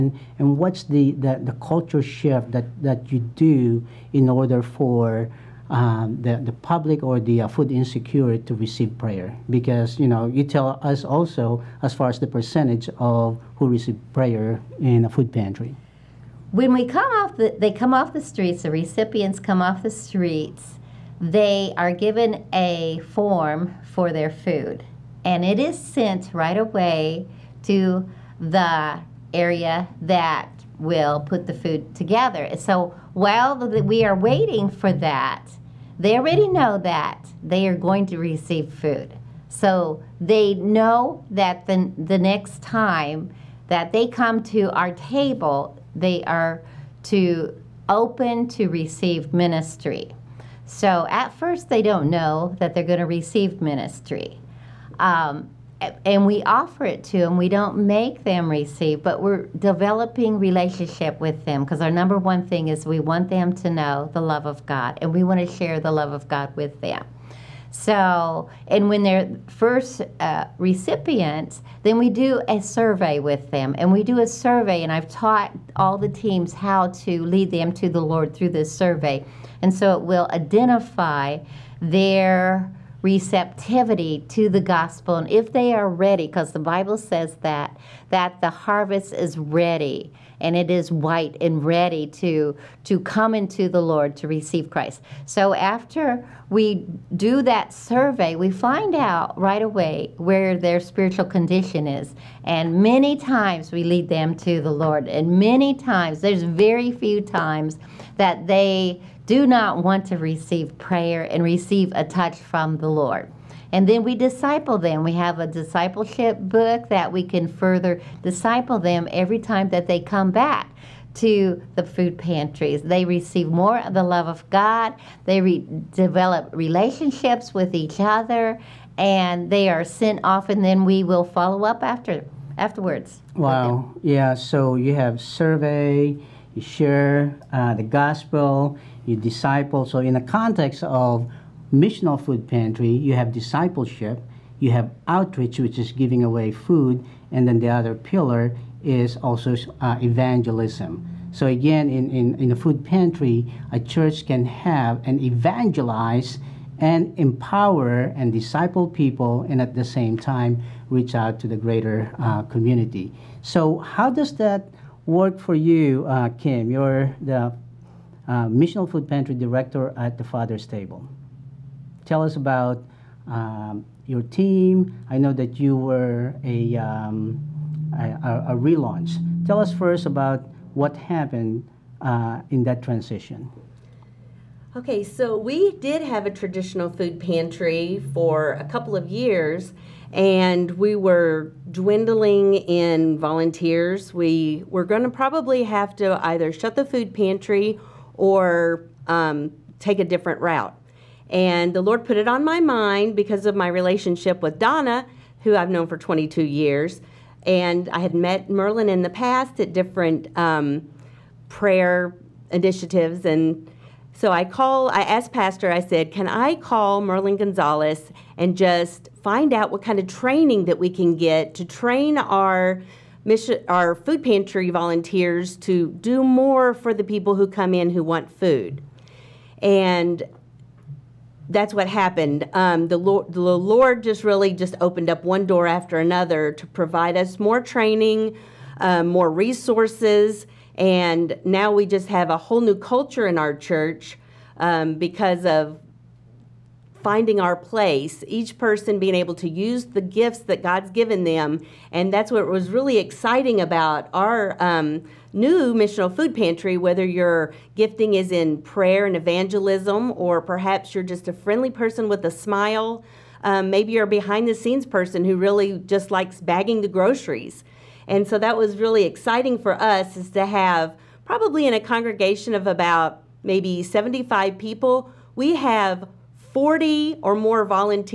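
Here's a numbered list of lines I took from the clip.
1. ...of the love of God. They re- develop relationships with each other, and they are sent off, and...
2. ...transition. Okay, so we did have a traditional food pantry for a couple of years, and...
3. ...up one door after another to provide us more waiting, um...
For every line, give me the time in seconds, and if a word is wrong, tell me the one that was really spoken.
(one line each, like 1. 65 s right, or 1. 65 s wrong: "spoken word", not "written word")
1. 123 s right
2. 182 s right
3. 235 s wrong: "training", not "waiting".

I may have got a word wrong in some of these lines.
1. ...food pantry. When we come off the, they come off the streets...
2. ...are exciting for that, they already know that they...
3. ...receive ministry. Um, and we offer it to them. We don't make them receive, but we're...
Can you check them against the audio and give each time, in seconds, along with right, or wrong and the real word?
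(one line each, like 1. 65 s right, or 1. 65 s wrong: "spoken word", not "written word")
1. 15 s right
2. 34 s wrong: "waiting", not "exciting"
3. 53 s right.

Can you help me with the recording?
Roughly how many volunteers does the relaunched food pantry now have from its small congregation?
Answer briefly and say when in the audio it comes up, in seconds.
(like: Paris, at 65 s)
40 or more, at 276 s.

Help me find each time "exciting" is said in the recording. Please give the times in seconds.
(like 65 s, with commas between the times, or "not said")
252 s, 269 s.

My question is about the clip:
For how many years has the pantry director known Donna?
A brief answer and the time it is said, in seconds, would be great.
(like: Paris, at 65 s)
22, at 205 s.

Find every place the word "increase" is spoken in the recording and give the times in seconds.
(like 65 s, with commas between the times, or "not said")
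not said.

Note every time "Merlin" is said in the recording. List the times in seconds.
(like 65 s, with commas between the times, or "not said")
208 s, 217 s.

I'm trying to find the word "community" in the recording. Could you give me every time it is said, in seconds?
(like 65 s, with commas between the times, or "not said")
162 s.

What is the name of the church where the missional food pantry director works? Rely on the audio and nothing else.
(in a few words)
The Father's Table.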